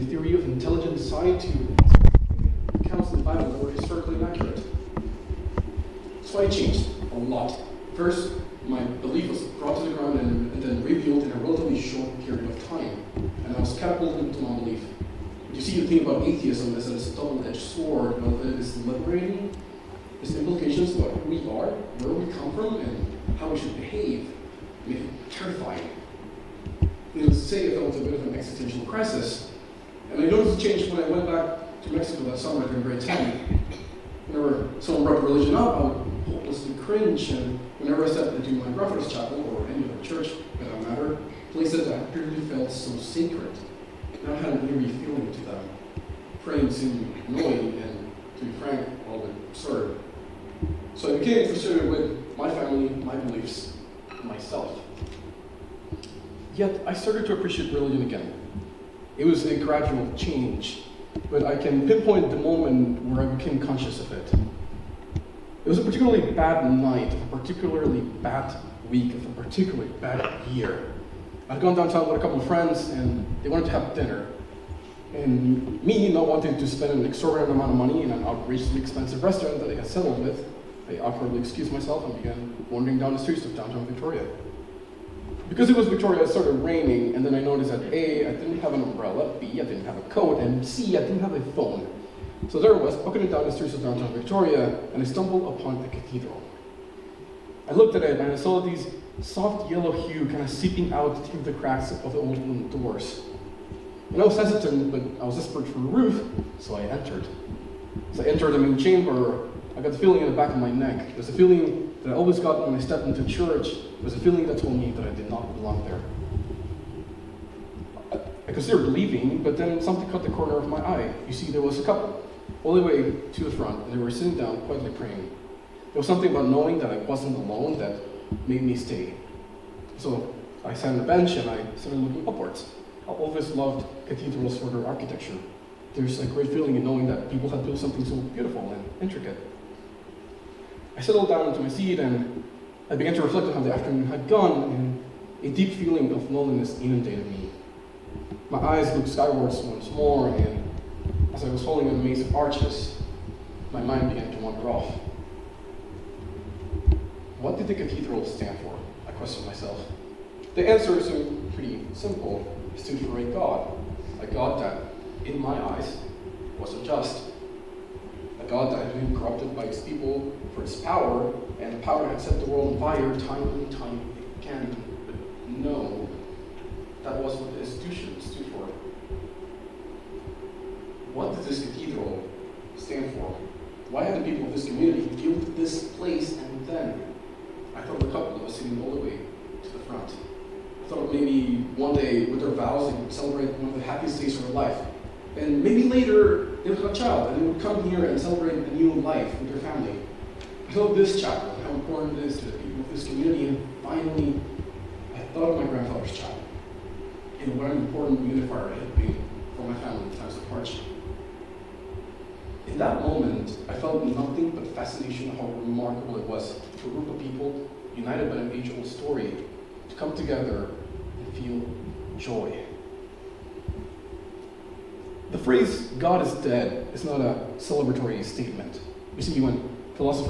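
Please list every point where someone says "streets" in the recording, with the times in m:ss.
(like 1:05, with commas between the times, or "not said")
1:23, 1:33.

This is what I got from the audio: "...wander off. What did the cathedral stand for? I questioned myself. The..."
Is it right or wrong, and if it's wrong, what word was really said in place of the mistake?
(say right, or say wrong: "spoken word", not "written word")
right.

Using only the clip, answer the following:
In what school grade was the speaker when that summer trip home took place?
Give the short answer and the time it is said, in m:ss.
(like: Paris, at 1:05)
grade 10, at 0:32.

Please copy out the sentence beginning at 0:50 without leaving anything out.
So I became frustrated with my family, my beliefs, myself.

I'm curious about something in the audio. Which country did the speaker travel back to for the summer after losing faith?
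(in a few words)
Mexico.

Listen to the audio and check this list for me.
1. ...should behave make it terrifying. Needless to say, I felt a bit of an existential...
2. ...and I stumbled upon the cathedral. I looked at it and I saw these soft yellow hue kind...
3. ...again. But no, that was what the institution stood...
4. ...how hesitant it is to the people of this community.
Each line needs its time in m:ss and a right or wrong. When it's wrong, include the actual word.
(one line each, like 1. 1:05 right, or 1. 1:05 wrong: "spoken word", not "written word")
1. 0:23 right
2. 1:34 right
3. 2:54 right
4. 3:21 wrong: "important", not "hesitant".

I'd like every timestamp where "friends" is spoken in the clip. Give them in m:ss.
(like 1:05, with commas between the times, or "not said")
1:12.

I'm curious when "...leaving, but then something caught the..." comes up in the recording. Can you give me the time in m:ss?
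1:58.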